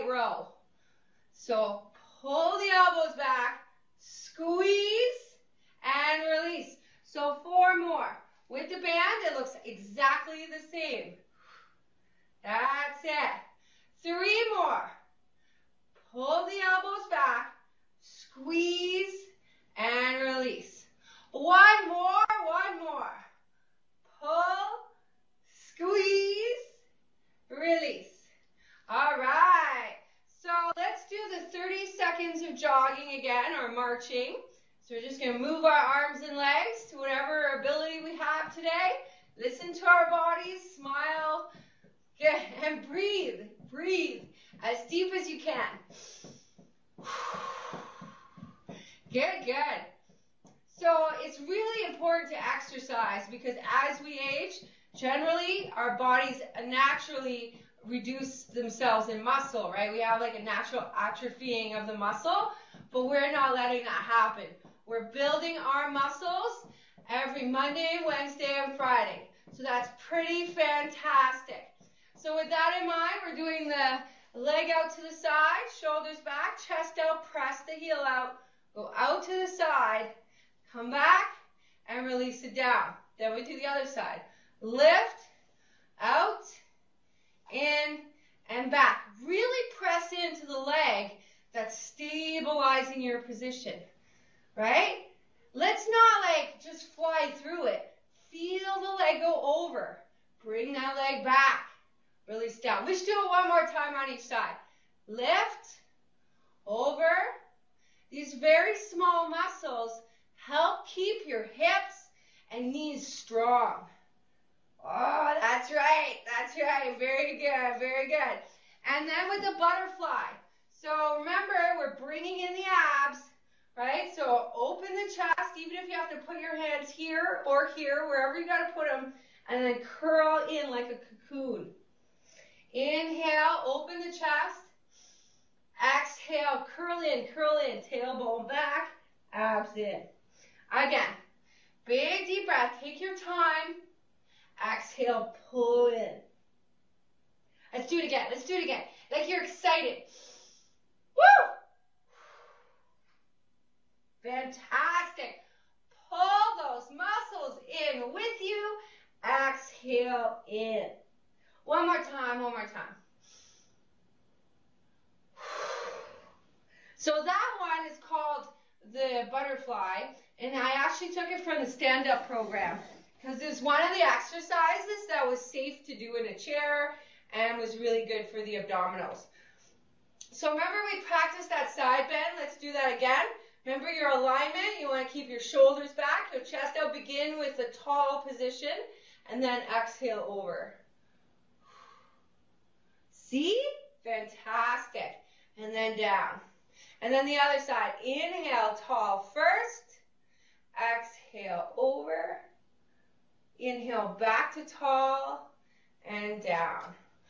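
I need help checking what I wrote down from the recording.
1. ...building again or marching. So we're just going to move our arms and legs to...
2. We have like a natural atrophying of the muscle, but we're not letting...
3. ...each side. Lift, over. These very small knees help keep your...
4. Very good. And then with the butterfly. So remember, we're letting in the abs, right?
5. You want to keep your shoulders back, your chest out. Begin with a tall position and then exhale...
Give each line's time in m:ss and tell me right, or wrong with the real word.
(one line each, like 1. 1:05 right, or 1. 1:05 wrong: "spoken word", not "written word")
1. 0:32 wrong: "jogging", not "building"
2. 0:59 right
3. 1:44 wrong: "muscles", not "knees"
4. 1:57 wrong: "bringing", not "letting"
5. 3:04 right.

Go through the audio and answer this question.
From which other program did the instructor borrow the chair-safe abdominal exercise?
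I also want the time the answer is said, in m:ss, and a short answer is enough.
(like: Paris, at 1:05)
the stand-up program, at 2:51.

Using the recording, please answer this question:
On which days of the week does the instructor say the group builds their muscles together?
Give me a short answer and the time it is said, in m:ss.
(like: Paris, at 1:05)
Monday, Wednesday, and Friday, at 1:07.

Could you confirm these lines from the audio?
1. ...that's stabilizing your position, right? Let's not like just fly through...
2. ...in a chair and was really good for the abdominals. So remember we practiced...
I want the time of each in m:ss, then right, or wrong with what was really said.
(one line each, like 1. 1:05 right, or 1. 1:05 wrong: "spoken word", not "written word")
1. 1:31 right
2. 2:56 right.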